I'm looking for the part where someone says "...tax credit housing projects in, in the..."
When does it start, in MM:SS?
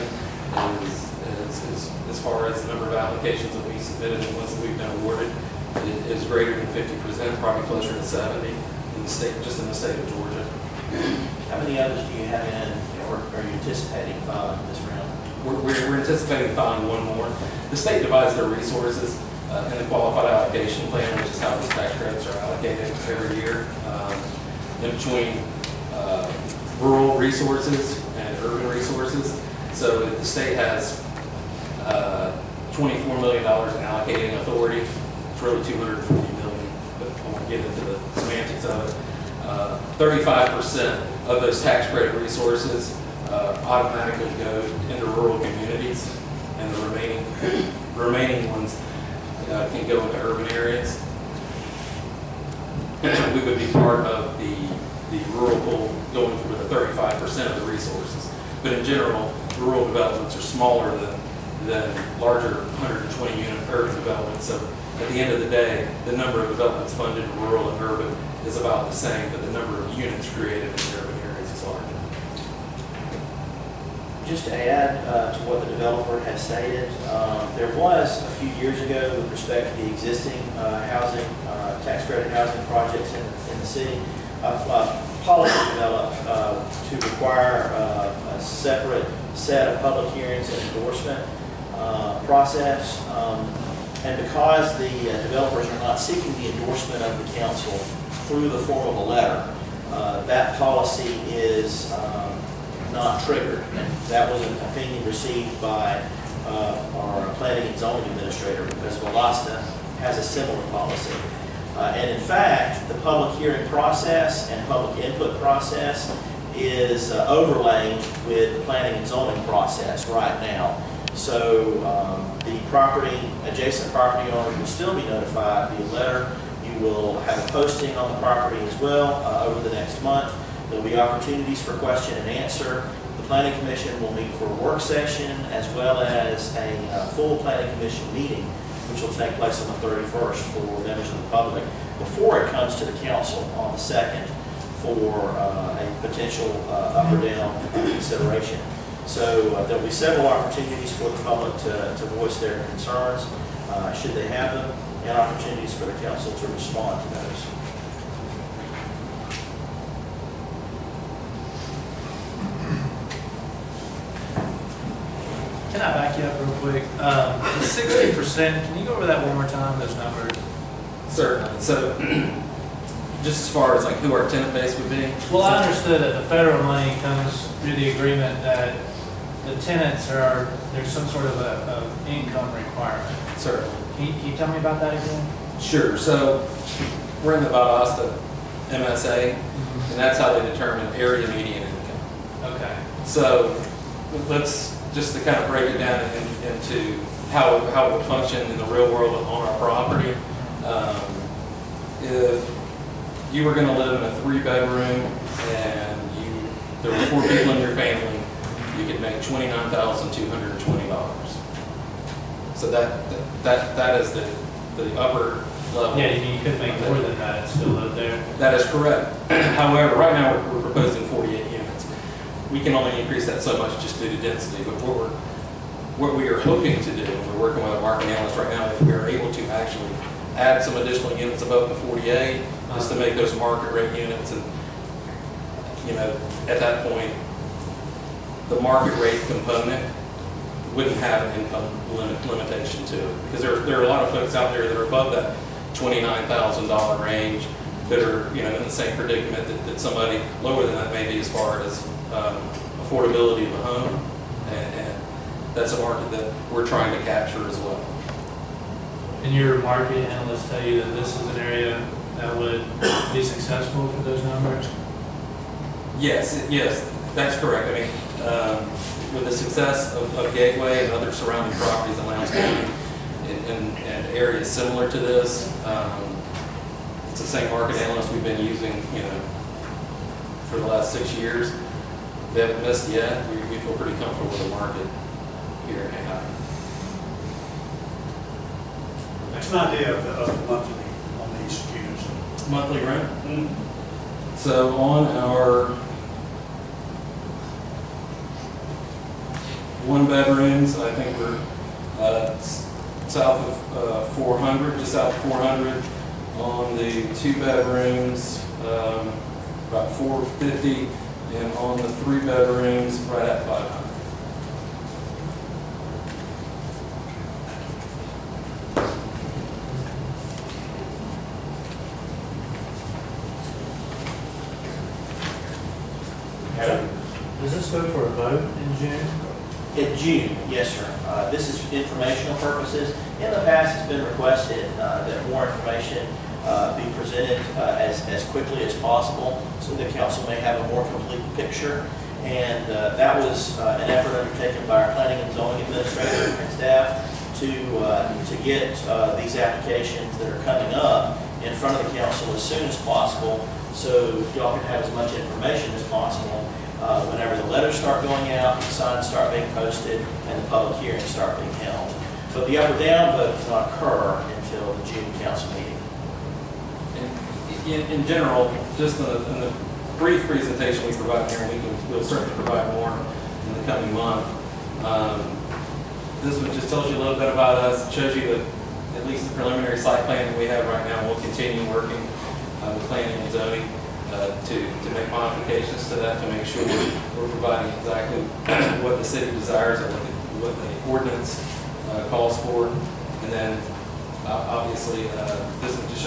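01:21.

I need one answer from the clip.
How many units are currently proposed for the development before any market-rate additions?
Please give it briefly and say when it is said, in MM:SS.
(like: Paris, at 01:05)
48, at 03:41.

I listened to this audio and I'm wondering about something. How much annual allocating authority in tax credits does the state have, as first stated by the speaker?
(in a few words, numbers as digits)
$24 million.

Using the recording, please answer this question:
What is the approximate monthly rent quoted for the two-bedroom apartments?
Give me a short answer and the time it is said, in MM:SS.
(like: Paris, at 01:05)
about 450, at 05:09.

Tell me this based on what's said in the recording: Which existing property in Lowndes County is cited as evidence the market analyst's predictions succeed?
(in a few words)
Gateway.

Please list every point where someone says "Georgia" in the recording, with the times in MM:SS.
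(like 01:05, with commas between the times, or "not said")
00:10.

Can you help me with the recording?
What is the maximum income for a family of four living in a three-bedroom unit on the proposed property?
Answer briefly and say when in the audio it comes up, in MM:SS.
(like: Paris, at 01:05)
$29,220, at 03:29.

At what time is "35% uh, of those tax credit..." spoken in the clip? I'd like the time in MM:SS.
00:39.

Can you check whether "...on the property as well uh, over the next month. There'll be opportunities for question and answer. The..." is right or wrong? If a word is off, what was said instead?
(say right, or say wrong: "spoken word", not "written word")
right.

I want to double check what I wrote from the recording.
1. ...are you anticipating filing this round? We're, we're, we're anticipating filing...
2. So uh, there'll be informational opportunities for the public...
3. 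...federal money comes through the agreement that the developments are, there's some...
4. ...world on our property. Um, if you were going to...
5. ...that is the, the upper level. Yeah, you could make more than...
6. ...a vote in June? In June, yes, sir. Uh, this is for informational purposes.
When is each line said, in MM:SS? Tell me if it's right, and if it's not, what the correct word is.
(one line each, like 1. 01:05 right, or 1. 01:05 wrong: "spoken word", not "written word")
1. 00:13 right
2. 02:29 wrong: "several", not "informational"
3. 02:56 wrong: "tenants", not "developments"
4. 03:18 right
5. 03:33 right
6. 05:28 right.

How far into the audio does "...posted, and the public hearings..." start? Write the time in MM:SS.
05:59.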